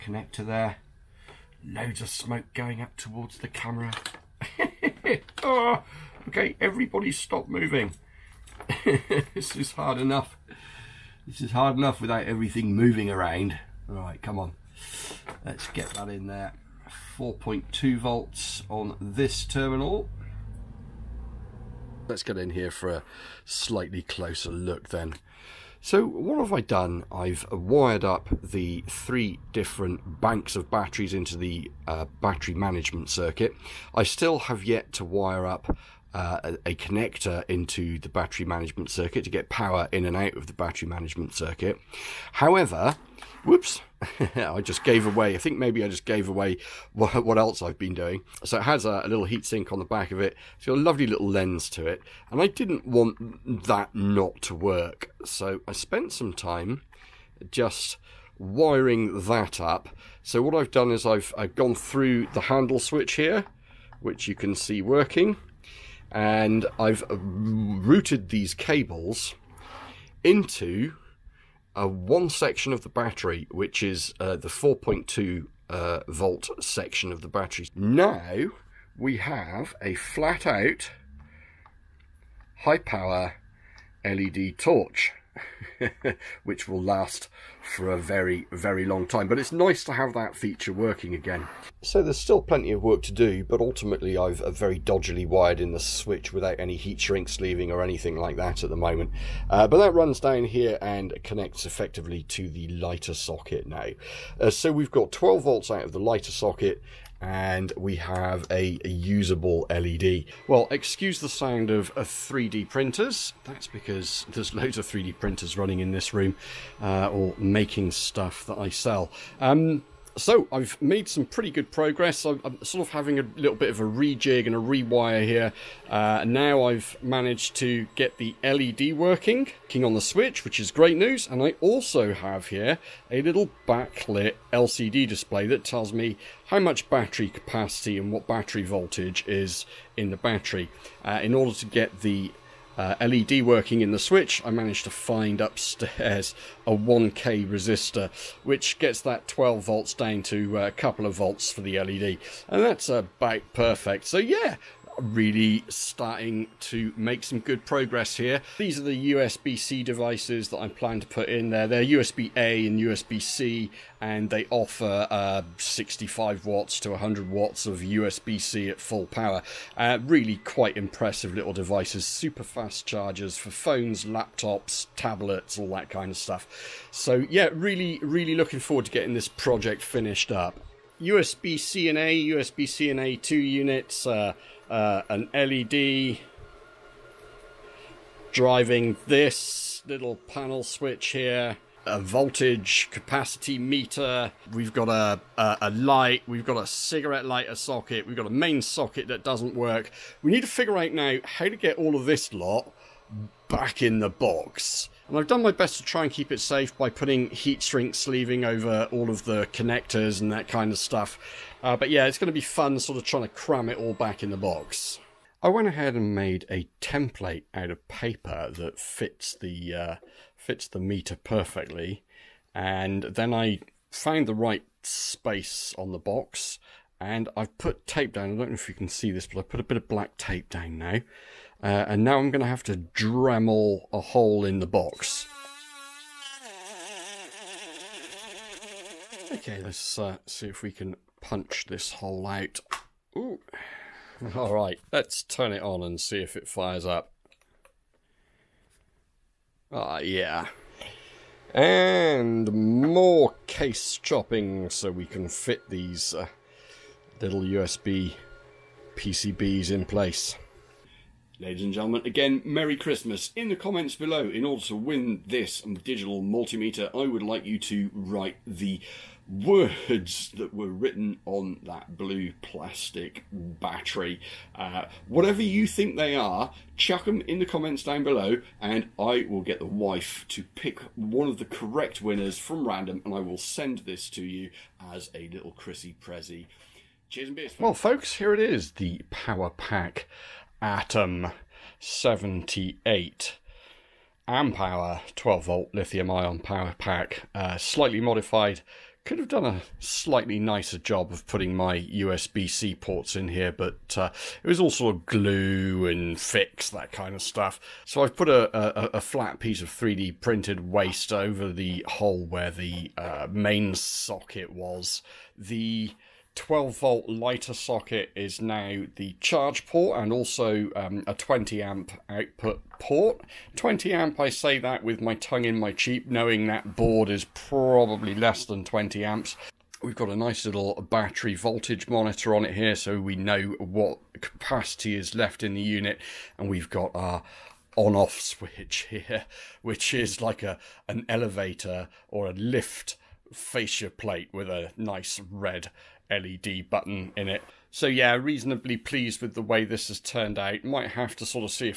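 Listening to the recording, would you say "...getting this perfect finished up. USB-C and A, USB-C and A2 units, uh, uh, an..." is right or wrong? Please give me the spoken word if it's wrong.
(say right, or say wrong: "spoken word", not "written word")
wrong: "project", not "perfect".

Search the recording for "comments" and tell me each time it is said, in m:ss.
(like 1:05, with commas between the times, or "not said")
4:23, 4:37.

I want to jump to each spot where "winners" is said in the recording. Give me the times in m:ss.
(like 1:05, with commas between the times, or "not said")
4:42.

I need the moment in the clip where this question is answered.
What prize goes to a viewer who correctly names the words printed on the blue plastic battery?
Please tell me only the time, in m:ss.
4:25.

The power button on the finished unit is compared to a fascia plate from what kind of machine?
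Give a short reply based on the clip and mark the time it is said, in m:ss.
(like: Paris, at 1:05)
elevator, at 5:41.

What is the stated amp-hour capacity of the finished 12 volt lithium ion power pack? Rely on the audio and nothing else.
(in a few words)
78 amp hour.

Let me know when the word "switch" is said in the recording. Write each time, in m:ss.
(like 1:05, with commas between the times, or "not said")
1:02, 1:35, 2:10, 2:23, 3:10, 5:38.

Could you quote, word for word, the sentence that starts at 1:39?
Uh, but that runs down here and connects effectively to the lighter socket now.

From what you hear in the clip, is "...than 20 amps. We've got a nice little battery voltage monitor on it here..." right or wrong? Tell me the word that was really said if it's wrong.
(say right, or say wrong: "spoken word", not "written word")
right.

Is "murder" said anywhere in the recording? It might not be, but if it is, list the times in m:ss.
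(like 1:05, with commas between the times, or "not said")
not said.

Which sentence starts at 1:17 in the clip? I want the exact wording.
Now we have a flat out high power LED torch.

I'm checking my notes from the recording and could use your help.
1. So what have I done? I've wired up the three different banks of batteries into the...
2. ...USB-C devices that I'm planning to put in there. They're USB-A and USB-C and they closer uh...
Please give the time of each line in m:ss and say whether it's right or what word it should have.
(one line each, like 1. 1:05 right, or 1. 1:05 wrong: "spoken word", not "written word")
1. 0:25 right
2. 2:39 wrong: "offer", not "closer".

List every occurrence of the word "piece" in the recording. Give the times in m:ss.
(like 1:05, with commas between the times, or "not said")
5:09.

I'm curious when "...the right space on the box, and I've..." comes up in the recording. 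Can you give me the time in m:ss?
3:44.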